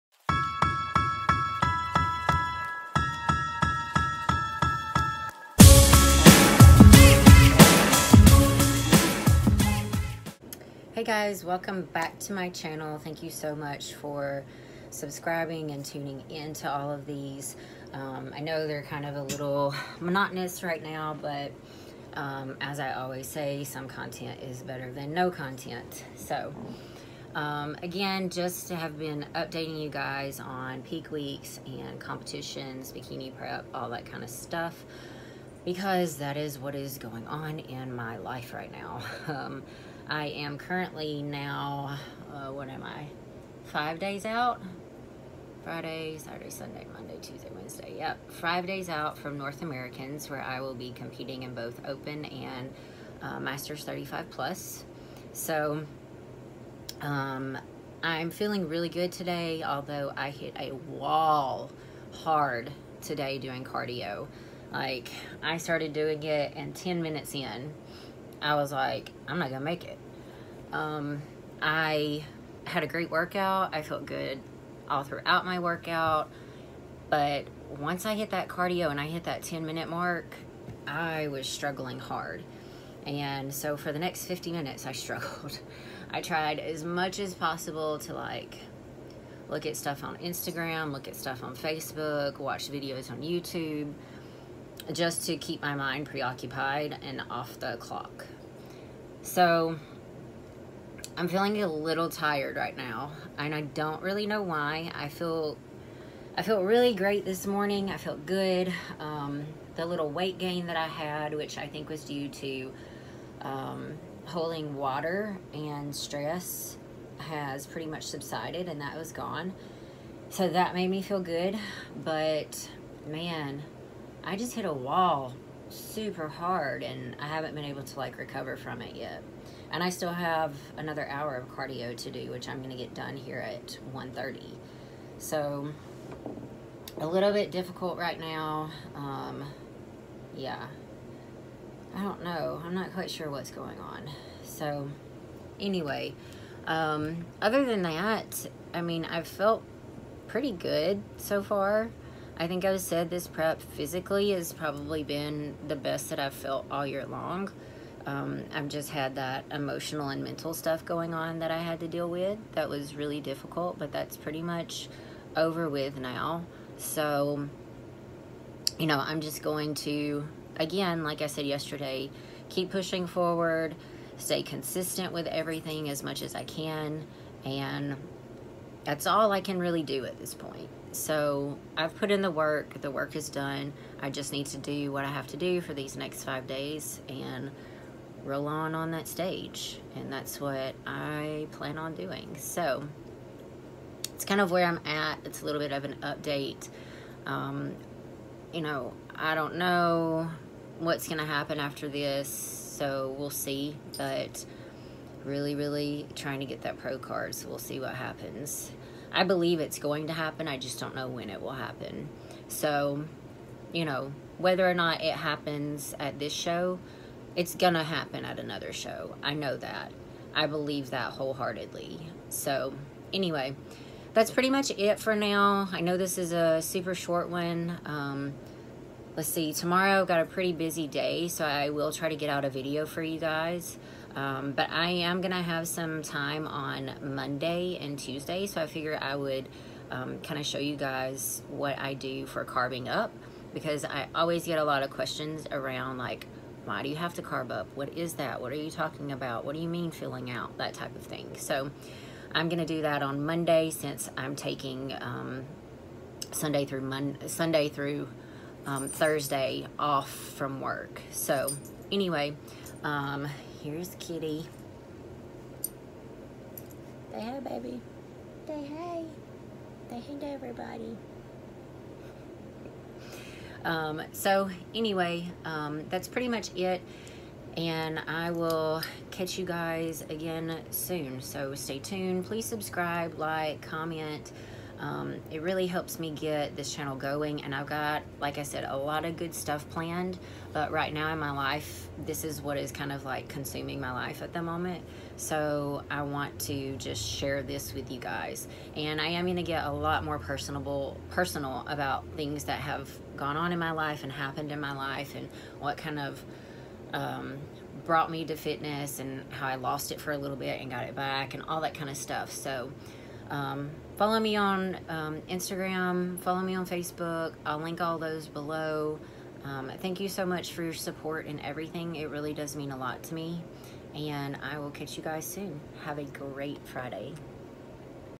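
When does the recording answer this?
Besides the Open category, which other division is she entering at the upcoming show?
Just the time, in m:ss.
0:53.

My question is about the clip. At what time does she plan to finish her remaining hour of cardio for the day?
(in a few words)
1:30.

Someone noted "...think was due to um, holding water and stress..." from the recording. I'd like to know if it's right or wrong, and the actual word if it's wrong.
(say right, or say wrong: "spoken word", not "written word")
right.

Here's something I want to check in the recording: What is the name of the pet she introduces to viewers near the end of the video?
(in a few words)
Kitty.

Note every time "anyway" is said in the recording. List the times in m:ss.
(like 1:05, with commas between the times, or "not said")
2:25, 3:43, 4:21, 4:34.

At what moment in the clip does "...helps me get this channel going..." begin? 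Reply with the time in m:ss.
4:45.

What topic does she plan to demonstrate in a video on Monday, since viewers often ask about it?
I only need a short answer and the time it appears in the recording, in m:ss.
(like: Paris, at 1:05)
carbing up, at 4:02.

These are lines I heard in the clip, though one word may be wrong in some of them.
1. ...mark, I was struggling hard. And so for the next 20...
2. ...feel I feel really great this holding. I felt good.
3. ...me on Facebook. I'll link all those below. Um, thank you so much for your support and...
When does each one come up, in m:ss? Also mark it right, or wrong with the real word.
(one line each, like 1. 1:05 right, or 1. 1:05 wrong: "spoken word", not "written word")
1. 1:19 wrong: "50", not "20"
2. 1:45 wrong: "morning", not "holding"
3. 5:16 right.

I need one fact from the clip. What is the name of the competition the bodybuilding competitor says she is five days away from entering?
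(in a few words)
North Americans.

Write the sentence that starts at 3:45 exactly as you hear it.
I know this is a super short one.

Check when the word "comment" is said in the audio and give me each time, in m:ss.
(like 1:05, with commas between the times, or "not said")
4:43.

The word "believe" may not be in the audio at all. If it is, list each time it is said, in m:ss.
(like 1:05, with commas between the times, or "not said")
3:29, 3:40.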